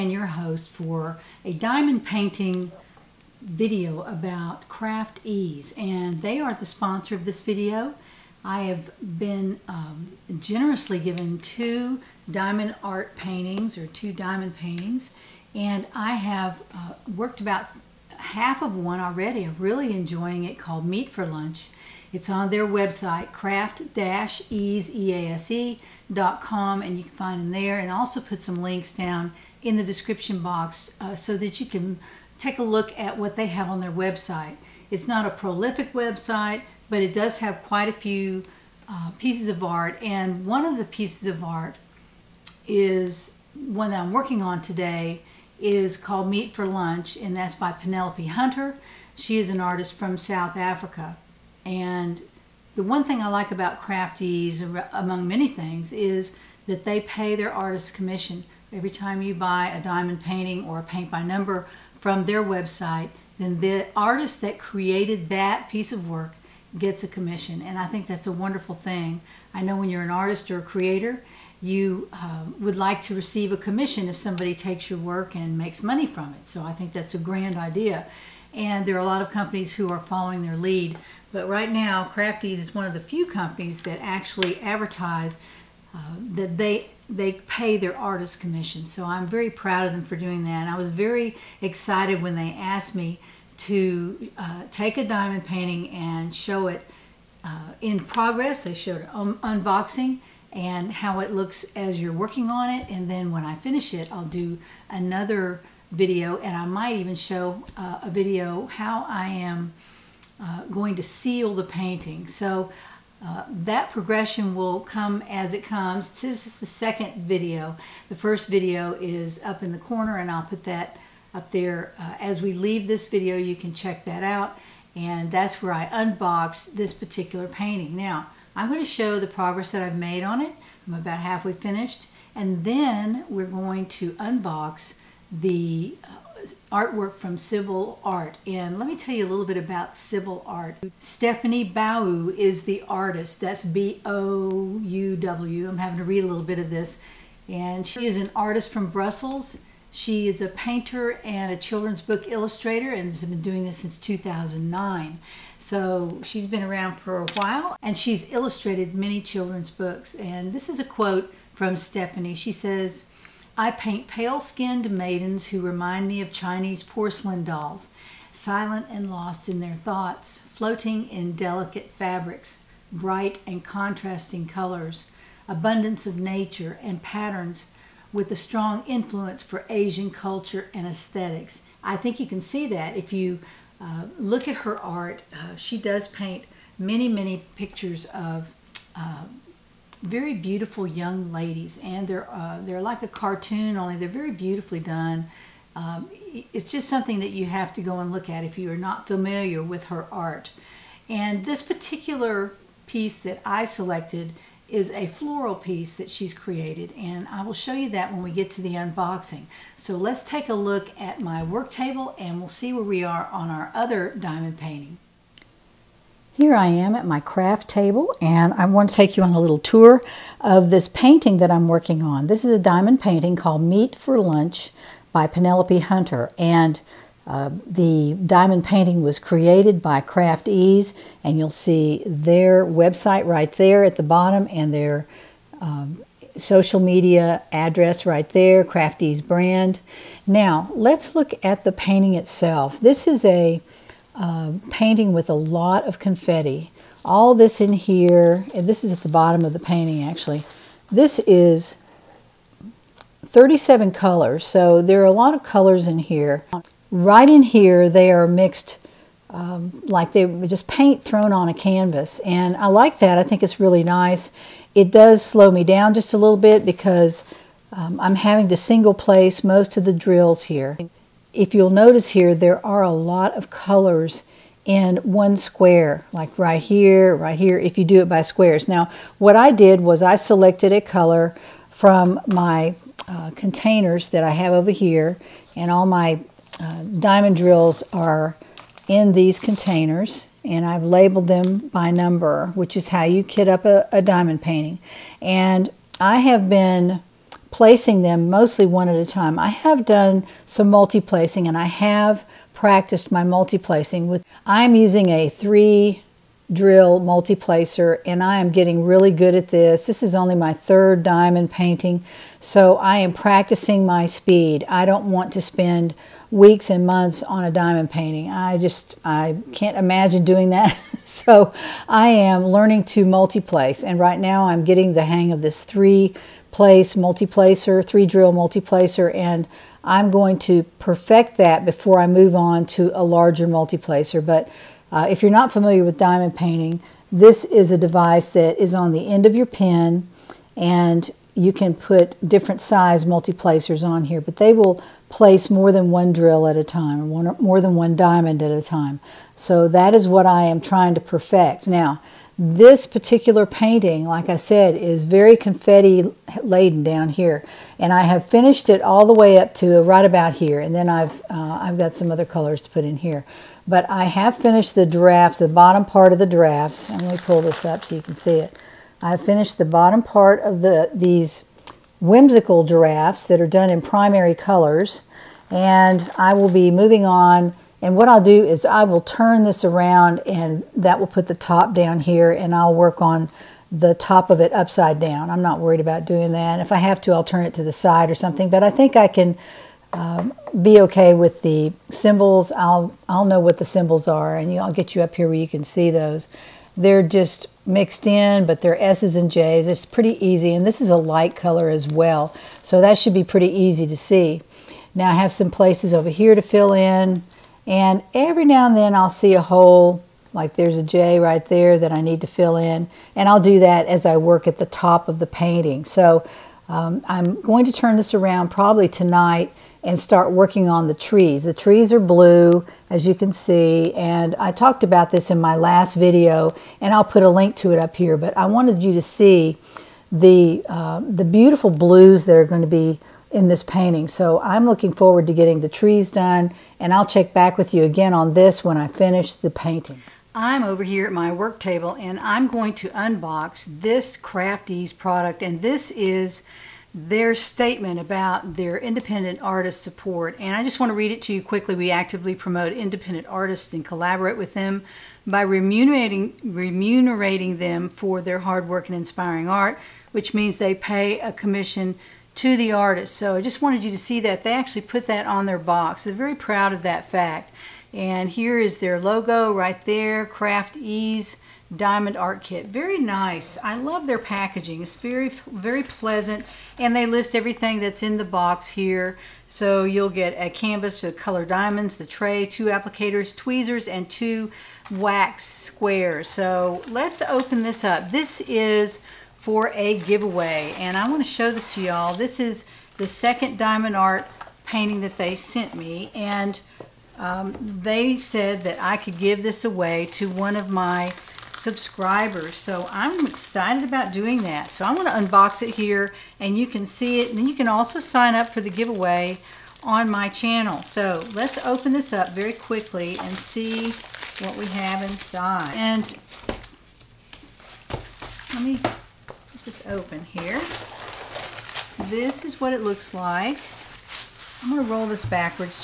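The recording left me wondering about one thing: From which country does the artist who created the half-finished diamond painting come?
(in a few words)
South Africa.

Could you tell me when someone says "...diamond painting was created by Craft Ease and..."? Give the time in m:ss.
3:48.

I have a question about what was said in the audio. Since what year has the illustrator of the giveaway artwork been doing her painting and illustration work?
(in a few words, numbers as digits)
2009.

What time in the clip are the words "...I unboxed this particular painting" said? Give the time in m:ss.
2:05.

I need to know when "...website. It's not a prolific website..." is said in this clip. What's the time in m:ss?
0:33.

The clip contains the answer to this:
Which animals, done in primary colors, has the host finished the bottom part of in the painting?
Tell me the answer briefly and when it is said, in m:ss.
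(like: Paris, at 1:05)
Giraffes, at 6:12.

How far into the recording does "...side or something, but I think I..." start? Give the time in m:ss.
6:27.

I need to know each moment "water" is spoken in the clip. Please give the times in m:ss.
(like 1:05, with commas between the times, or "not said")
not said.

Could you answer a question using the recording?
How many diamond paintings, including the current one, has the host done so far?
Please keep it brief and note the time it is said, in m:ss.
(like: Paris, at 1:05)
3, at 5:10.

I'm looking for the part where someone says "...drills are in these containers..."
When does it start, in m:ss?
4:47.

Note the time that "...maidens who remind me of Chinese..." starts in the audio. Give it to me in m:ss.
2:44.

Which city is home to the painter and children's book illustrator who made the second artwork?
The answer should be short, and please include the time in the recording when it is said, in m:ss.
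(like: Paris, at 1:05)
Brussels, at 2:28.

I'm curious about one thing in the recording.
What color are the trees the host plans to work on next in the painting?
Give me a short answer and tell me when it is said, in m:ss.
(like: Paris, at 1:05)
Blue, at 7:01.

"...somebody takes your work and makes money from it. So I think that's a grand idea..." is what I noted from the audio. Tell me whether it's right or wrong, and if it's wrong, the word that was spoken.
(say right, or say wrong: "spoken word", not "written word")
right.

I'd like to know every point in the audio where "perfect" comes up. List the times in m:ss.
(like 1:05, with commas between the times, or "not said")
5:30, 5:51.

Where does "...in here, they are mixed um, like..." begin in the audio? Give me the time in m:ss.
4:17.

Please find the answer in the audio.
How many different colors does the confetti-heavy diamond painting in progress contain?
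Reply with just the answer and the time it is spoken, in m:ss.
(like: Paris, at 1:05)
37, at 4:13.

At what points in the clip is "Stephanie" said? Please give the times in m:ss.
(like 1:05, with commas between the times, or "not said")
2:20, 2:41.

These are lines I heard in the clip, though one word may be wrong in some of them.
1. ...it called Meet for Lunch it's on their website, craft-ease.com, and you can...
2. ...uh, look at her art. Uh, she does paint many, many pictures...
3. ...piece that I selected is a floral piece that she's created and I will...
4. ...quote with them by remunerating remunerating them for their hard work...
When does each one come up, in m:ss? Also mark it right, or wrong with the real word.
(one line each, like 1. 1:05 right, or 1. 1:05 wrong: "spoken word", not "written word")
1. 0:20 right
2. 3:03 right
3. 3:22 right
4. 7:33 wrong: "collaborate", not "quote".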